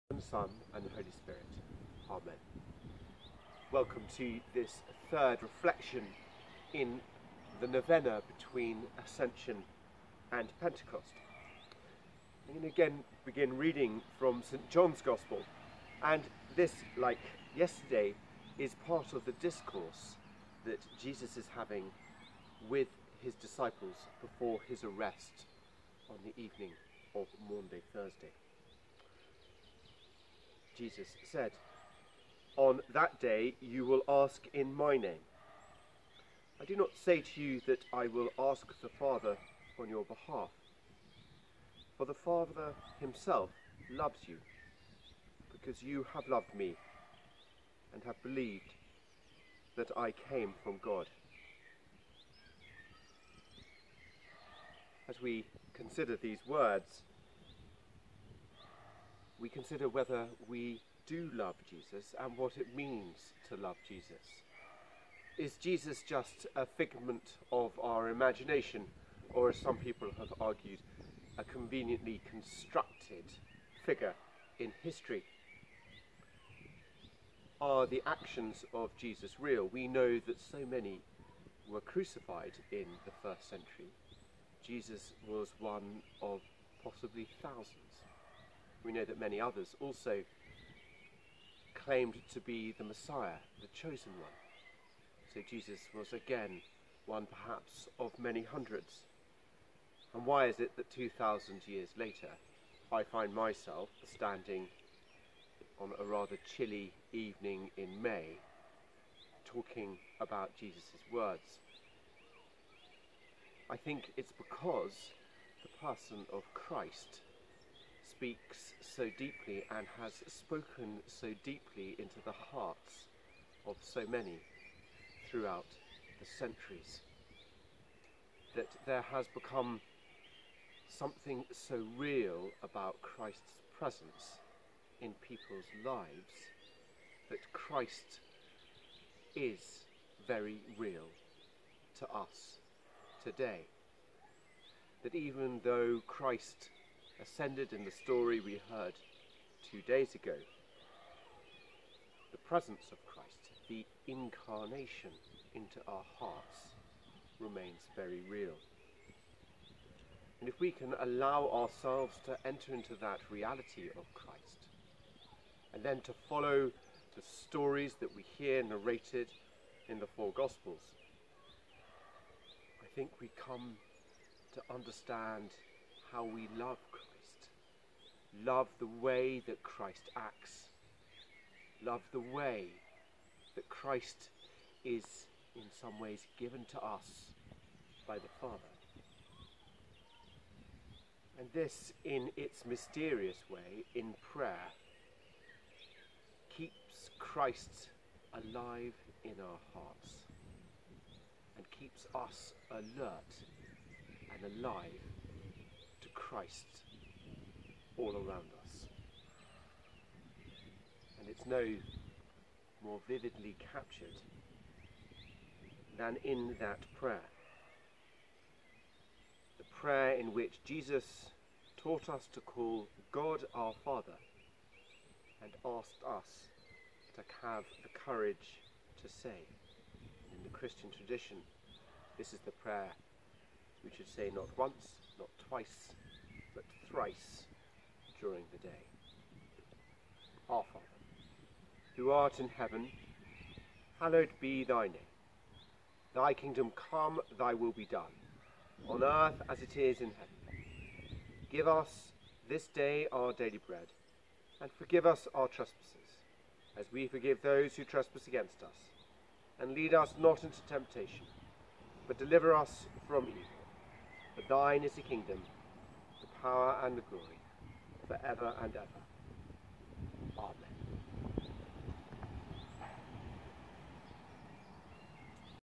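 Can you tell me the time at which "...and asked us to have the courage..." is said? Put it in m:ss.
3:45.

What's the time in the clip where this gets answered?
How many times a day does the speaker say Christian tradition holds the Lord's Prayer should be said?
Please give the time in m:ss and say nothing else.
3:56.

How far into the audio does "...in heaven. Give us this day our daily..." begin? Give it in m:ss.
4:10.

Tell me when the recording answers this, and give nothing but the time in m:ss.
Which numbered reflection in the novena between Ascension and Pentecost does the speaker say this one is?
0:05.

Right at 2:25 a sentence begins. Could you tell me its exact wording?
That even though Christ ascended in the story we heard two days ago.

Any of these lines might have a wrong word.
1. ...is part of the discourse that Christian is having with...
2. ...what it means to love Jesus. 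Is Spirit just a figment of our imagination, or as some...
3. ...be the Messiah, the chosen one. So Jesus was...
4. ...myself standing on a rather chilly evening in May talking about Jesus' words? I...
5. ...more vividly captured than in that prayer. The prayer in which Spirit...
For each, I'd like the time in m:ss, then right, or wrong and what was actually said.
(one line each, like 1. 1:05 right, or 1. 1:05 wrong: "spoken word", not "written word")
1. 0:18 wrong: "Jesus", not "Christian"
2. 1:02 wrong: "Jesus", not "Spirit"
3. 1:32 right
4. 1:43 right
5. 3:32 wrong: "Jesus", not "Spirit".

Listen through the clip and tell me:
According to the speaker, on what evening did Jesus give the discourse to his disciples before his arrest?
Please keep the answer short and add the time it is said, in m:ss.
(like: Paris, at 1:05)
Maundy Thursday, at 0:27.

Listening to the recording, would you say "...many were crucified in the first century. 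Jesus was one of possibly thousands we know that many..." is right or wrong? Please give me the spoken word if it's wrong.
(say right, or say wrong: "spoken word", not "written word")
right.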